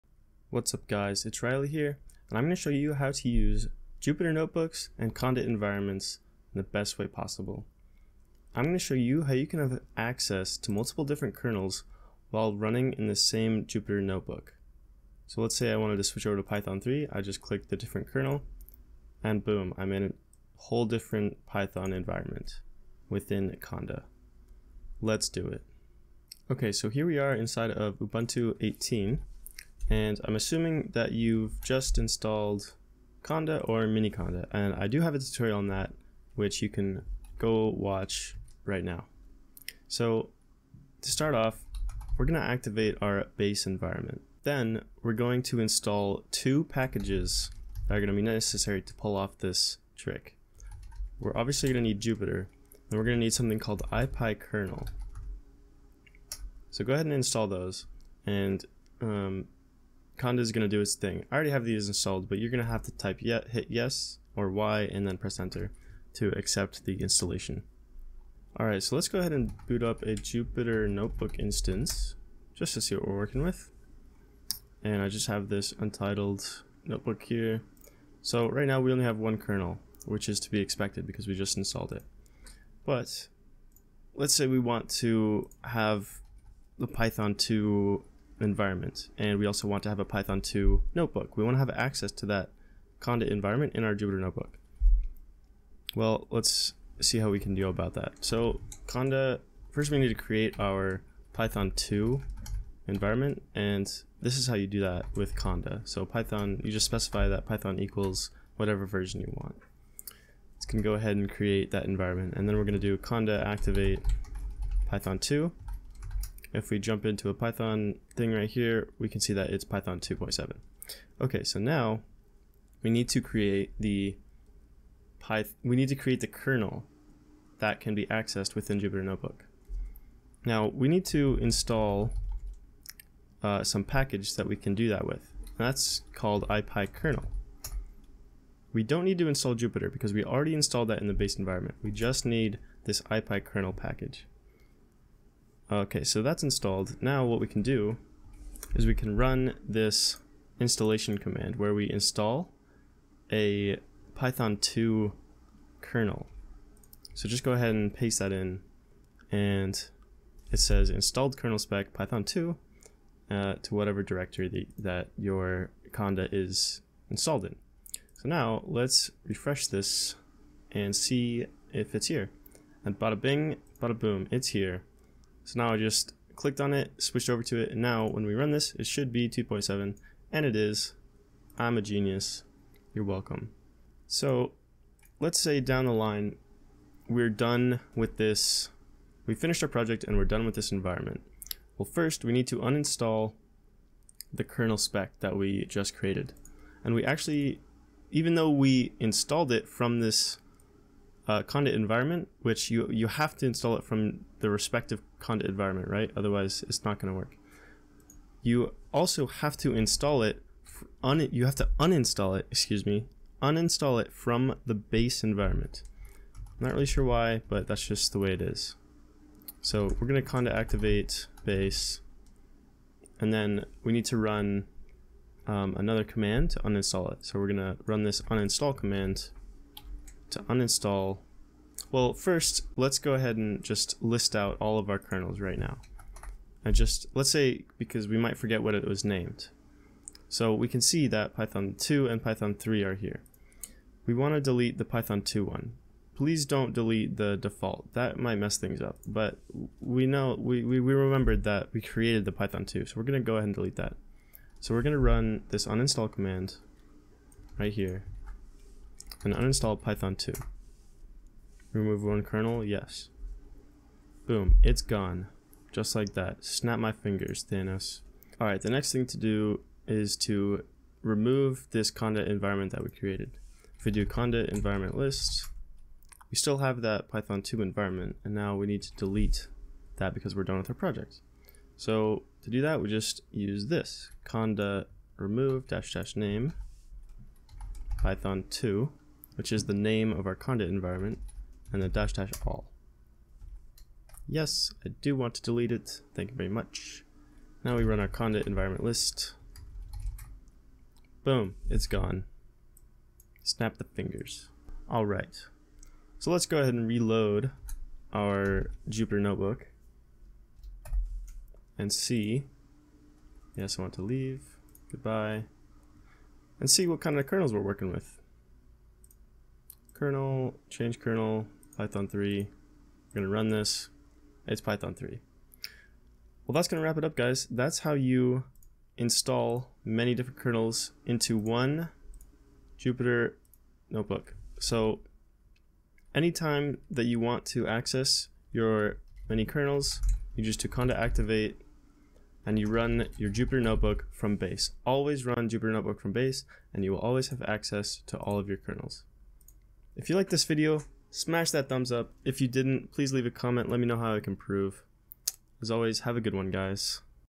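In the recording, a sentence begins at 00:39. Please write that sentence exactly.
So to start off we're going to activate our base environment.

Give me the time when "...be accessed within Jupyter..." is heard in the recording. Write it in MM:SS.
02:07.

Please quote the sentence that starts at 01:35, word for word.
Well, let's see how we can deal about that.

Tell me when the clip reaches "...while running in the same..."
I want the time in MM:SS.
00:12.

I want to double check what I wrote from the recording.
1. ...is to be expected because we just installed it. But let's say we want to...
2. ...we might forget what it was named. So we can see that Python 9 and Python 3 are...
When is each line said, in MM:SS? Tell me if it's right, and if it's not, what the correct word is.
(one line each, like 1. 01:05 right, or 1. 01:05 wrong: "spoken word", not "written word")
1. 01:20 right
2. 03:58 wrong: "2", not "9".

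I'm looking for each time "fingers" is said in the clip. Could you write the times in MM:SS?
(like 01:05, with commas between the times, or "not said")
04:26, 05:03.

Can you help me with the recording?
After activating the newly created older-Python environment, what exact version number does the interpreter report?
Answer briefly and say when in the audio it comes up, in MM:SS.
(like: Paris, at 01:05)
2.7, at 01:59.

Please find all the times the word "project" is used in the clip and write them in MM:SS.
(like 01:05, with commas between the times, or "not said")
03:09, 04:40.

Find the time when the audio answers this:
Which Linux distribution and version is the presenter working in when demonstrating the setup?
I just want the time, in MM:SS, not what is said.
00:27.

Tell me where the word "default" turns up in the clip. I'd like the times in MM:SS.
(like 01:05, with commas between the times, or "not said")
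04:07.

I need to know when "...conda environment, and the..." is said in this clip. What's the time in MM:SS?
04:50.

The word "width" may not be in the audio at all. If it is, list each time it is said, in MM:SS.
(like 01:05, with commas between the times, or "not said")
not said.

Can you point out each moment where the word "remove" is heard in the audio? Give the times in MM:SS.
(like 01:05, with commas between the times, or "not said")
04:21, 04:31, 04:45.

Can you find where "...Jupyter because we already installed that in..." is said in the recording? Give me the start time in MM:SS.
02:19.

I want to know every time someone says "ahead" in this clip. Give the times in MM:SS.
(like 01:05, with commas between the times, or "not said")
00:56, 01:09, 01:50, 02:37, 03:53, 04:13, 05:06.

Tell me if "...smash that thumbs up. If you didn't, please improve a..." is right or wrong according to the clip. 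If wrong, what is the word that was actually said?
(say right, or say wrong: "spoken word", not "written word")
wrong: "leave", not "improve".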